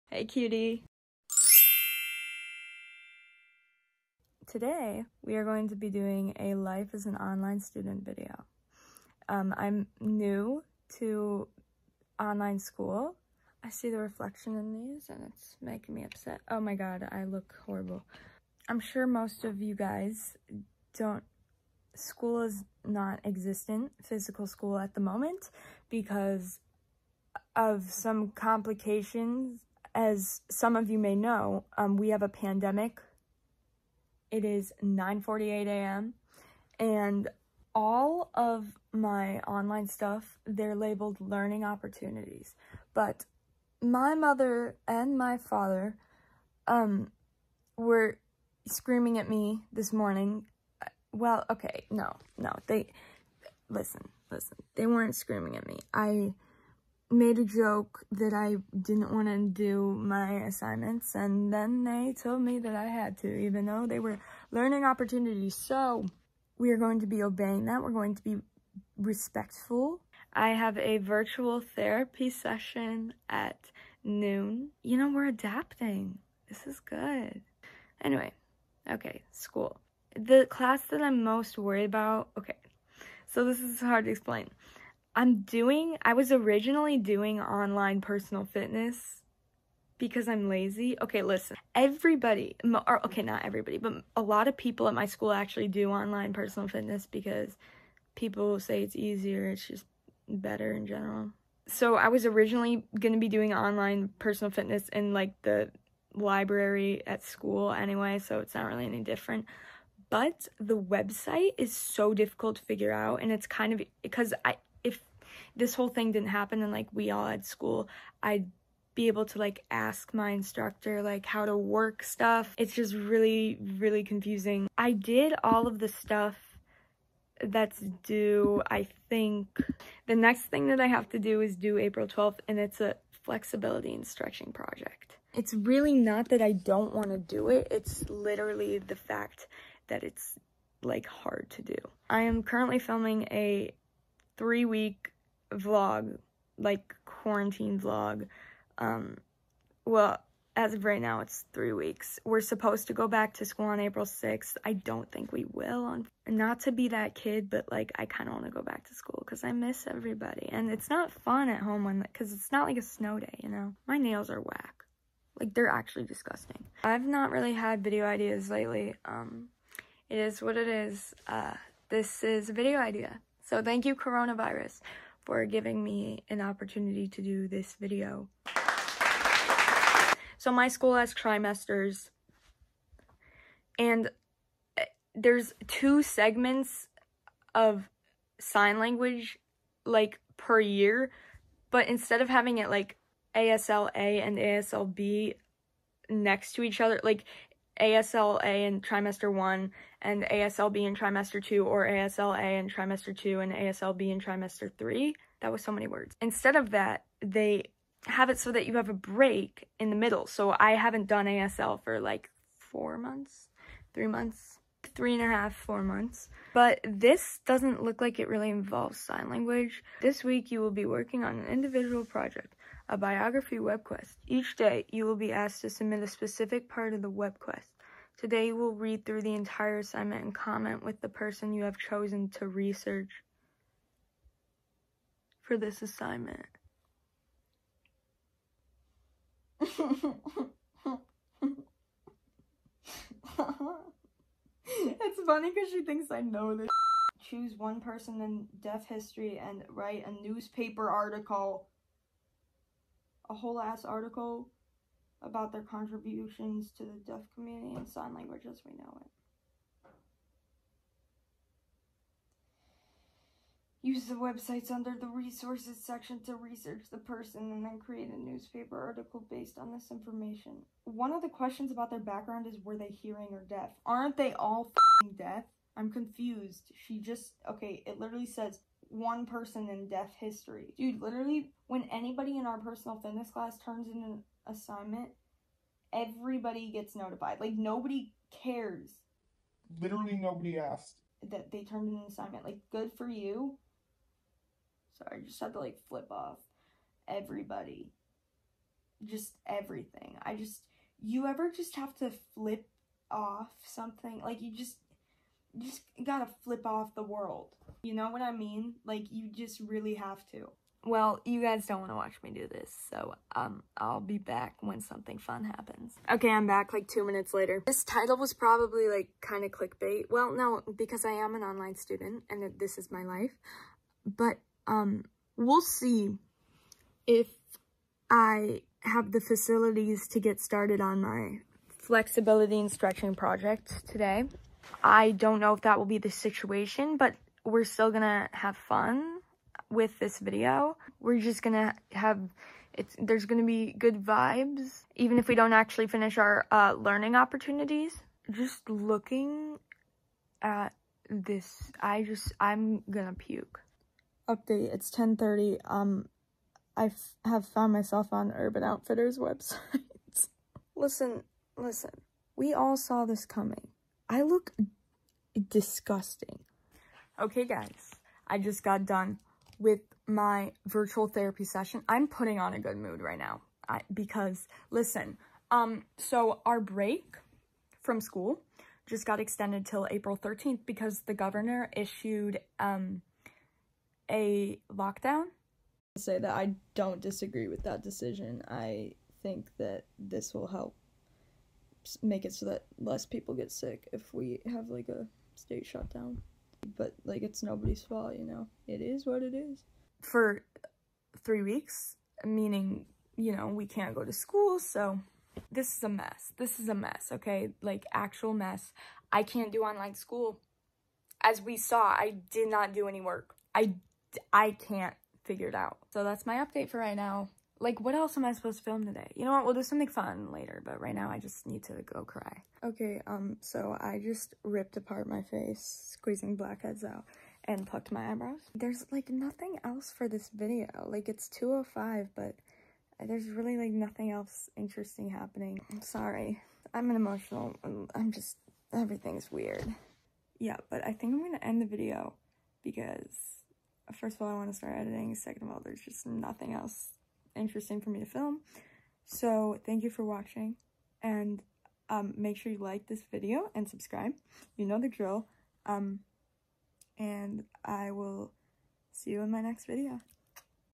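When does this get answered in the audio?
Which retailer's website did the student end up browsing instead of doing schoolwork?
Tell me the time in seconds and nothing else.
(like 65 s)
358 s.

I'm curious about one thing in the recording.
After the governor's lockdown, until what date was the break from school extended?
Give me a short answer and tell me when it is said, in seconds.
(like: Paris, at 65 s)
April 13th, at 379 s.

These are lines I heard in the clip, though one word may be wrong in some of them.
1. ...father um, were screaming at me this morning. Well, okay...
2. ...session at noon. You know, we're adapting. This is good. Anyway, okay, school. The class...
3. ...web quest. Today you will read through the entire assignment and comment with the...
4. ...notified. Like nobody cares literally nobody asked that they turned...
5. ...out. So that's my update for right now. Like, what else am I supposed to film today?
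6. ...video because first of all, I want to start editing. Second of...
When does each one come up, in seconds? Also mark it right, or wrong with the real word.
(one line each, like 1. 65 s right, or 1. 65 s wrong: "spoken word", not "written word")
1. 45 s right
2. 72 s right
3. 227 s right
4. 286 s right
5. 415 s right
6. 441 s right.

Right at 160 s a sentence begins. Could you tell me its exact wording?
And it's not fun at home when because it's not like a snow day, you know?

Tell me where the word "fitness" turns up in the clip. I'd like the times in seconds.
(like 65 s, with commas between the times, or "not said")
88 s, 96 s, 104 s, 282 s.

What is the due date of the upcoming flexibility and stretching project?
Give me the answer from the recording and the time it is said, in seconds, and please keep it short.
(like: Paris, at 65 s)
April 12th, at 131 s.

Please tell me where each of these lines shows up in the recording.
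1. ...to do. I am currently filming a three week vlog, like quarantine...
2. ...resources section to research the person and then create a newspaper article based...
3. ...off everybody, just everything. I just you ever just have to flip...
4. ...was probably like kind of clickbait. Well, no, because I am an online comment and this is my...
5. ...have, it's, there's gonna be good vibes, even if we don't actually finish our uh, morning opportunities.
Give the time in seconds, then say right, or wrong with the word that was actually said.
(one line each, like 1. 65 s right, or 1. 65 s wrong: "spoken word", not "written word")
1. 141 s right
2. 265 s right
3. 296 s right
4. 318 s wrong: "student", not "comment"
5. 341 s wrong: "learning", not "morning".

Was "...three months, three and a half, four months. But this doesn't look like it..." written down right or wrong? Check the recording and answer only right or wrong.
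right.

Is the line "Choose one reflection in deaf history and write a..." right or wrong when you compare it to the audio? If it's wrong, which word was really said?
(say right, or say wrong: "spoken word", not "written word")
wrong: "person", not "reflection".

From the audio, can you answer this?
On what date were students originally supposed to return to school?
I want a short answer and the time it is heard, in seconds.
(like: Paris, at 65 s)
April 6th, at 153 s.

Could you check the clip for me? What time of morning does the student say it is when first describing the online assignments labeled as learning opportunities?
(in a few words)
9:48 a.m.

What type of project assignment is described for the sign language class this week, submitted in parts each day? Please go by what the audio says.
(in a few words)
Biography web quest.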